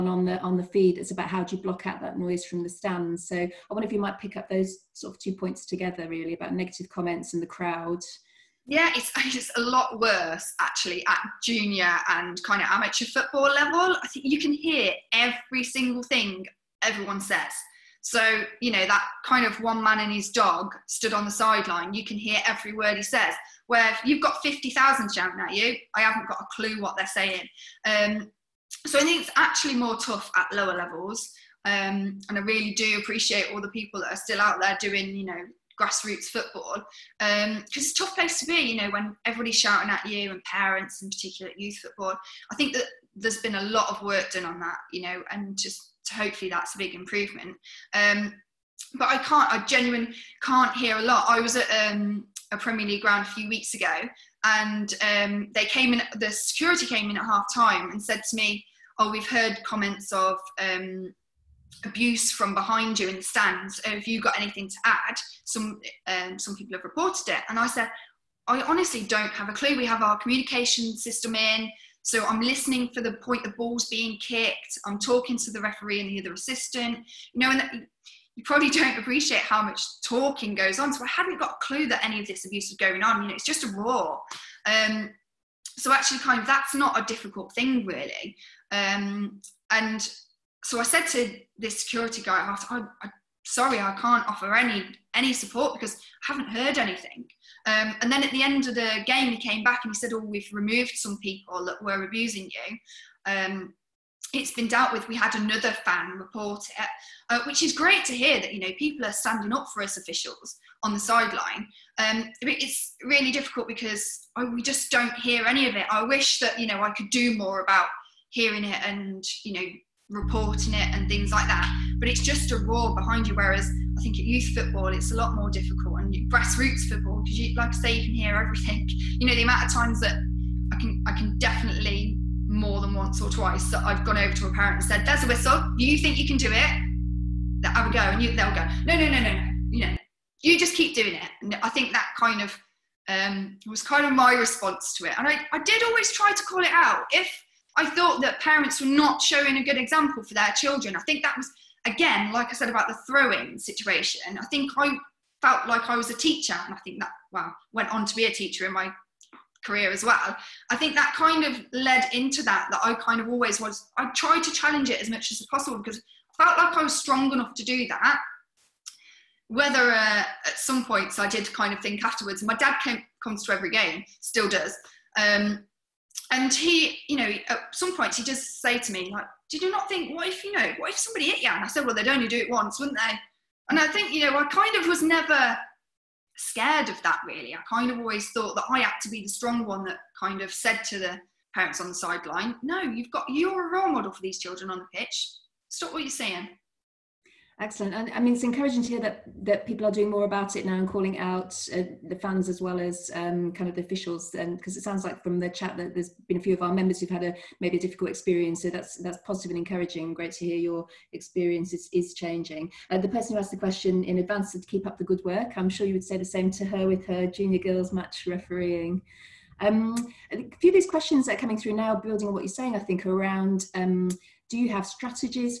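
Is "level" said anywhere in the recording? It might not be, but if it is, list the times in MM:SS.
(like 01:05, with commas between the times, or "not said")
00:13, 00:30.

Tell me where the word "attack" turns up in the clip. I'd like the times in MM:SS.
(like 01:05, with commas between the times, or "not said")
not said.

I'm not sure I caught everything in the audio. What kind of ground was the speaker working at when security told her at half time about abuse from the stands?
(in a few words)
Premier League.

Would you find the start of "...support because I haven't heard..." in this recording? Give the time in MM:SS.
01:35.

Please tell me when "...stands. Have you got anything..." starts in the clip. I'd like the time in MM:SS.
01:03.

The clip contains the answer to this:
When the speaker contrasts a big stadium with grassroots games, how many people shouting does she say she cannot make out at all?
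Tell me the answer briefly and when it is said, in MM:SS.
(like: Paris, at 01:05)
50,000, at 00:24.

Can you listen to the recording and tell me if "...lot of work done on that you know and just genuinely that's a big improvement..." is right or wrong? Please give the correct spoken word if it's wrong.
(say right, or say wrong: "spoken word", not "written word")
wrong: "hopefully", not "genuinely".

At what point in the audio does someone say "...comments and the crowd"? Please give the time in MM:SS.
00:06.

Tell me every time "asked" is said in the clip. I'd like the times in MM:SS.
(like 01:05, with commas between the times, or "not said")
01:32, 03:33.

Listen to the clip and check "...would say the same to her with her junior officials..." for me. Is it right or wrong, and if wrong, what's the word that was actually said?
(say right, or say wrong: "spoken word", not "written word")
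wrong: "girls", not "officials".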